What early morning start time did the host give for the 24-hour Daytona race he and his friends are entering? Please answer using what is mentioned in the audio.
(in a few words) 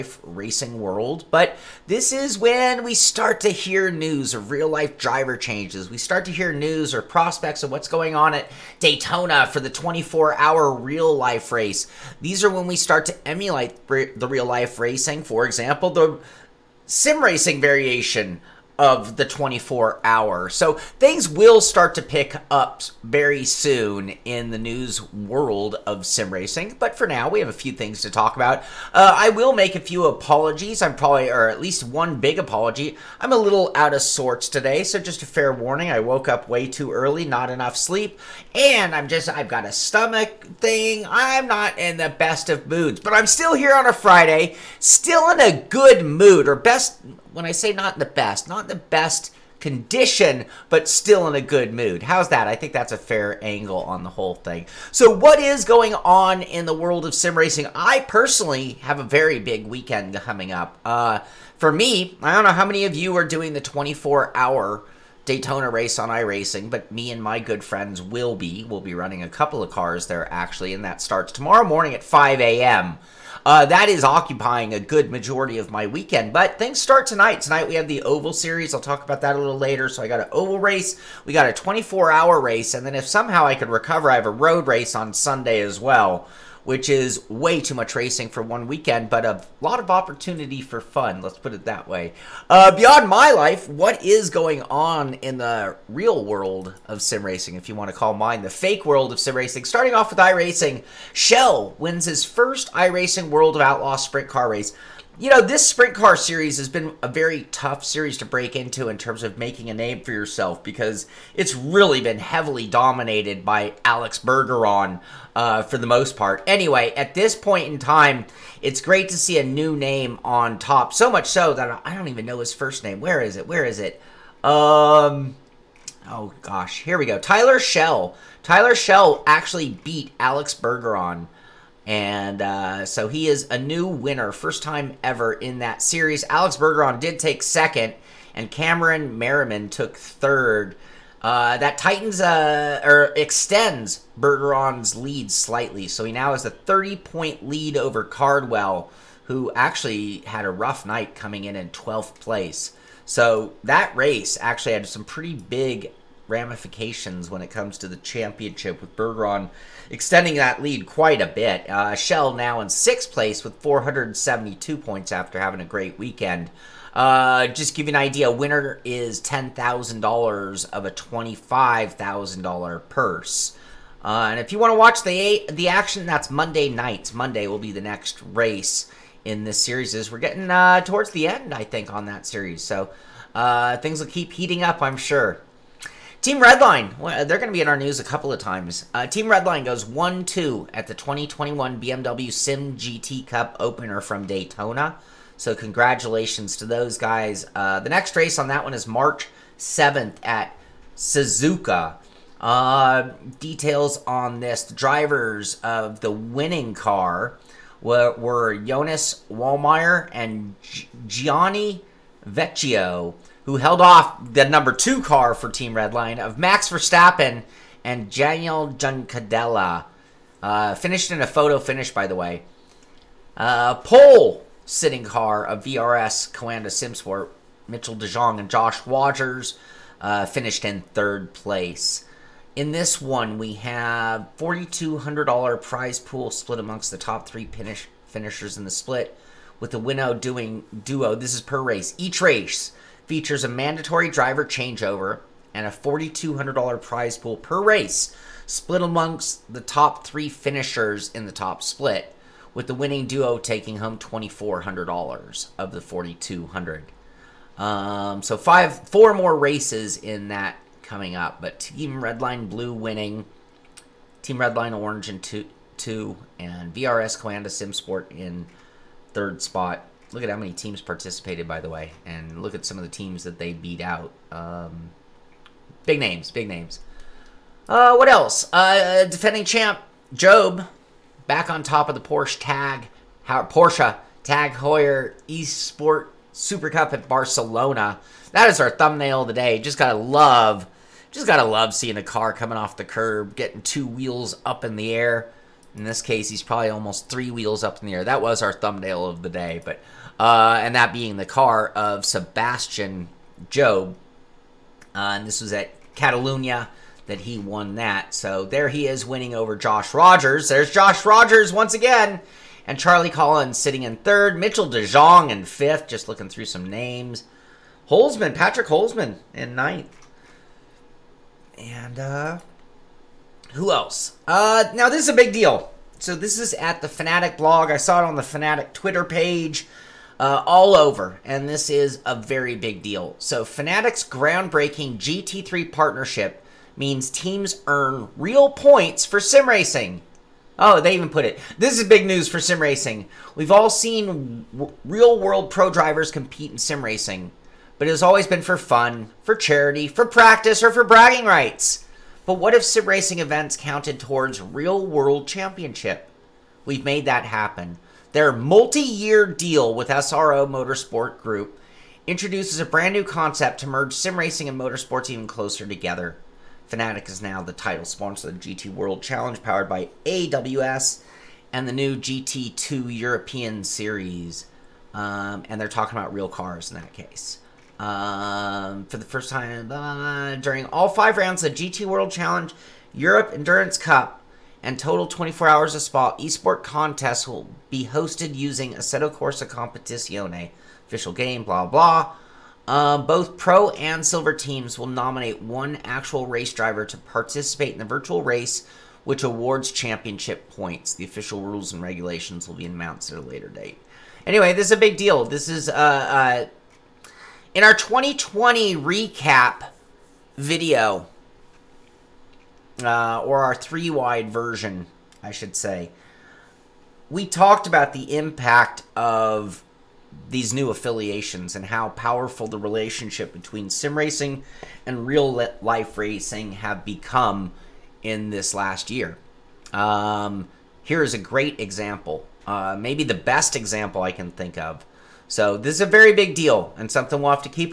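5 a.m.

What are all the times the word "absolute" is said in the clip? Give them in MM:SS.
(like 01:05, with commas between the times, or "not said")
not said.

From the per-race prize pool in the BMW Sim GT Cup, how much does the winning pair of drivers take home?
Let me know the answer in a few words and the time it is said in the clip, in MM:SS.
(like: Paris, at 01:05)
$2,400, at 04:13.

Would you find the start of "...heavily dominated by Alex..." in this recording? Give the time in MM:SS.
01:52.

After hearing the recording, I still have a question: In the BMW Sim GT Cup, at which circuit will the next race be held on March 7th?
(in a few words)
Suzuka.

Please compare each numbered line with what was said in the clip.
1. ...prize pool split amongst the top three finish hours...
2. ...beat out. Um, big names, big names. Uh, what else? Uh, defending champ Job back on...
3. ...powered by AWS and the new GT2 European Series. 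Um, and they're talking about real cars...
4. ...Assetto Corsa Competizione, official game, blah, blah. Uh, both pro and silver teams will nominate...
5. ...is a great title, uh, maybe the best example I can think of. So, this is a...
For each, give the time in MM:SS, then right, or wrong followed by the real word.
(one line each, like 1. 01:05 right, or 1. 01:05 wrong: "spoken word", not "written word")
1. 03:55 wrong: "finishers", not "hours"
2. 04:33 right
3. 06:09 right
4. 06:28 right
5. 07:11 wrong: "example", not "title".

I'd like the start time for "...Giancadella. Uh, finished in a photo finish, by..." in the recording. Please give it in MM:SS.
03:38.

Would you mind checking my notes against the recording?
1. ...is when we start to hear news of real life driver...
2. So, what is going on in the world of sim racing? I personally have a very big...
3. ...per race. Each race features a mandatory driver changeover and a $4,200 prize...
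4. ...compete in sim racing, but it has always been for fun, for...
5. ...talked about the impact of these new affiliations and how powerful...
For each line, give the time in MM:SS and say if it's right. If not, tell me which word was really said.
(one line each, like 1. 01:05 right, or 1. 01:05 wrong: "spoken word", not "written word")
1. 00:02 right
2. 00:54 right
3. 04:01 right
4. 05:46 right
5. 06:57 right.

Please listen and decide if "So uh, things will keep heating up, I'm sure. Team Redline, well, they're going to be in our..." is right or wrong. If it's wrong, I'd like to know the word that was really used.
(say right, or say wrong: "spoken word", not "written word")
right.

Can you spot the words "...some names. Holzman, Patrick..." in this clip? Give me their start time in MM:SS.
05:16.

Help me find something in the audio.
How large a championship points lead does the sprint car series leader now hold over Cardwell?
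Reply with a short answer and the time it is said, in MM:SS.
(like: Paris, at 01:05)
30 points, at 02:26.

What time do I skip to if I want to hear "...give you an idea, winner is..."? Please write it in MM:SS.
02:47.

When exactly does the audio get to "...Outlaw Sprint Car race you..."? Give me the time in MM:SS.
01:43.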